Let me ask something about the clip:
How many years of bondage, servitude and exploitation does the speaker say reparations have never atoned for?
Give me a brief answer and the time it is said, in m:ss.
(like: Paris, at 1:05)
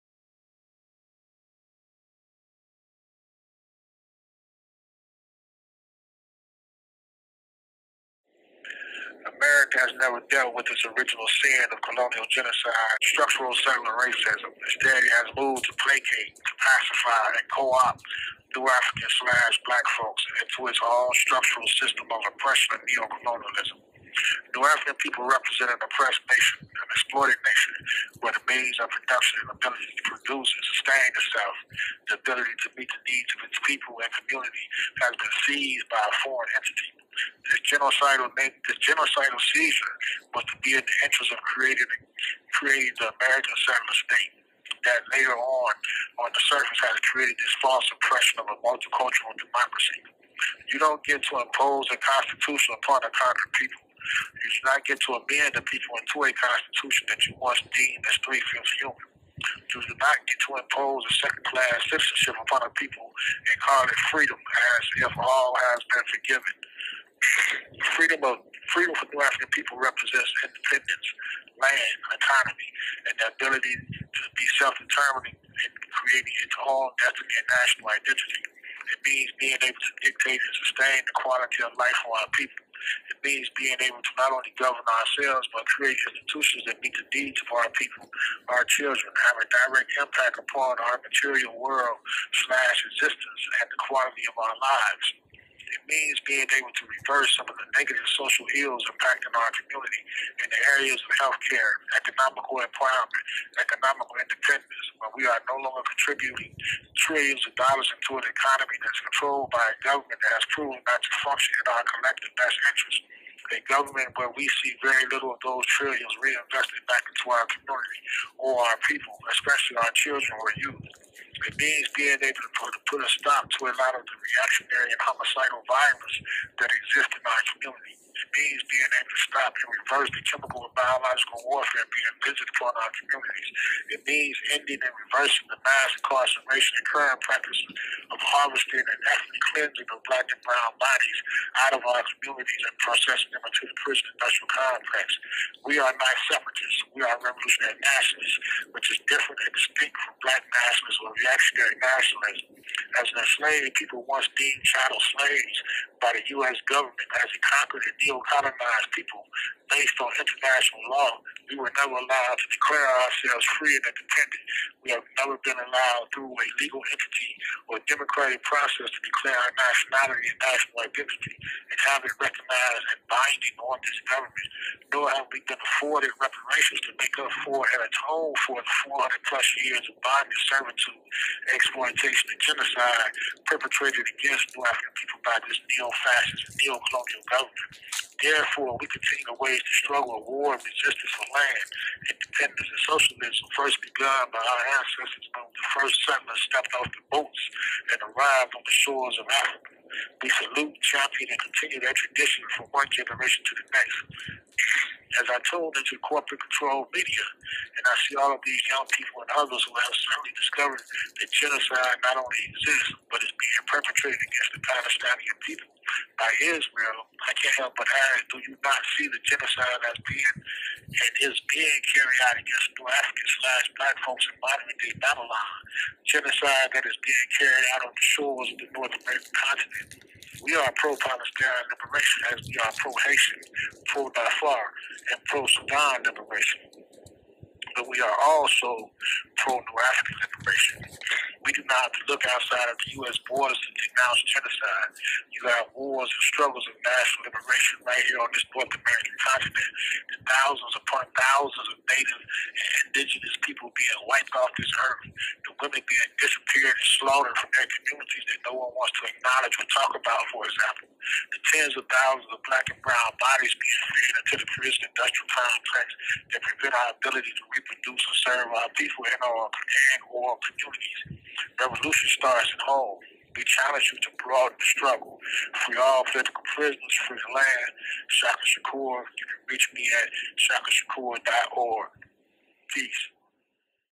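400 plus years, at 2:58.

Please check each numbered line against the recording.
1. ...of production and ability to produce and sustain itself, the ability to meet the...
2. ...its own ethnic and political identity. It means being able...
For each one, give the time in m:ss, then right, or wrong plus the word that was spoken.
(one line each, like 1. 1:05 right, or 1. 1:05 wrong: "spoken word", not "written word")
1. 0:28 right
2. 1:16 wrong: "national", not "political".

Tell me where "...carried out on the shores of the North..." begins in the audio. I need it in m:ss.
3:47.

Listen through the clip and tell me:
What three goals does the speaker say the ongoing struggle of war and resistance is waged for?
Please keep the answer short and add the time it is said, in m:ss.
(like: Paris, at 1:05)
land, independence, and socialism, at 3:11.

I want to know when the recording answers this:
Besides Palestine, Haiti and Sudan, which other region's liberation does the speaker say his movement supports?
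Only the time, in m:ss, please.
3:54.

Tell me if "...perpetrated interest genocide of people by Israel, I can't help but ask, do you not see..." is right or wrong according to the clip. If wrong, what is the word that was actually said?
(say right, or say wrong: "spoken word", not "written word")
wrong: "against", not "interest".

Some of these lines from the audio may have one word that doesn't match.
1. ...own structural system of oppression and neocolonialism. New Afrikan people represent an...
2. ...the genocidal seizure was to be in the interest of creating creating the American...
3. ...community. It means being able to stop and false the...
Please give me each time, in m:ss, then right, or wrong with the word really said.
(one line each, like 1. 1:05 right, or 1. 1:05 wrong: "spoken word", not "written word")
1. 0:20 right
2. 0:38 right
3. 2:07 wrong: "reverse", not "false".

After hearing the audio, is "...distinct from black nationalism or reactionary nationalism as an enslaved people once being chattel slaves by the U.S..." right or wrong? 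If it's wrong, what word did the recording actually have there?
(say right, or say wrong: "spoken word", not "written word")
right.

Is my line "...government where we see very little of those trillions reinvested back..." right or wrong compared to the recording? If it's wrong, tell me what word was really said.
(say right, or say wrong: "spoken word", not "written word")
right.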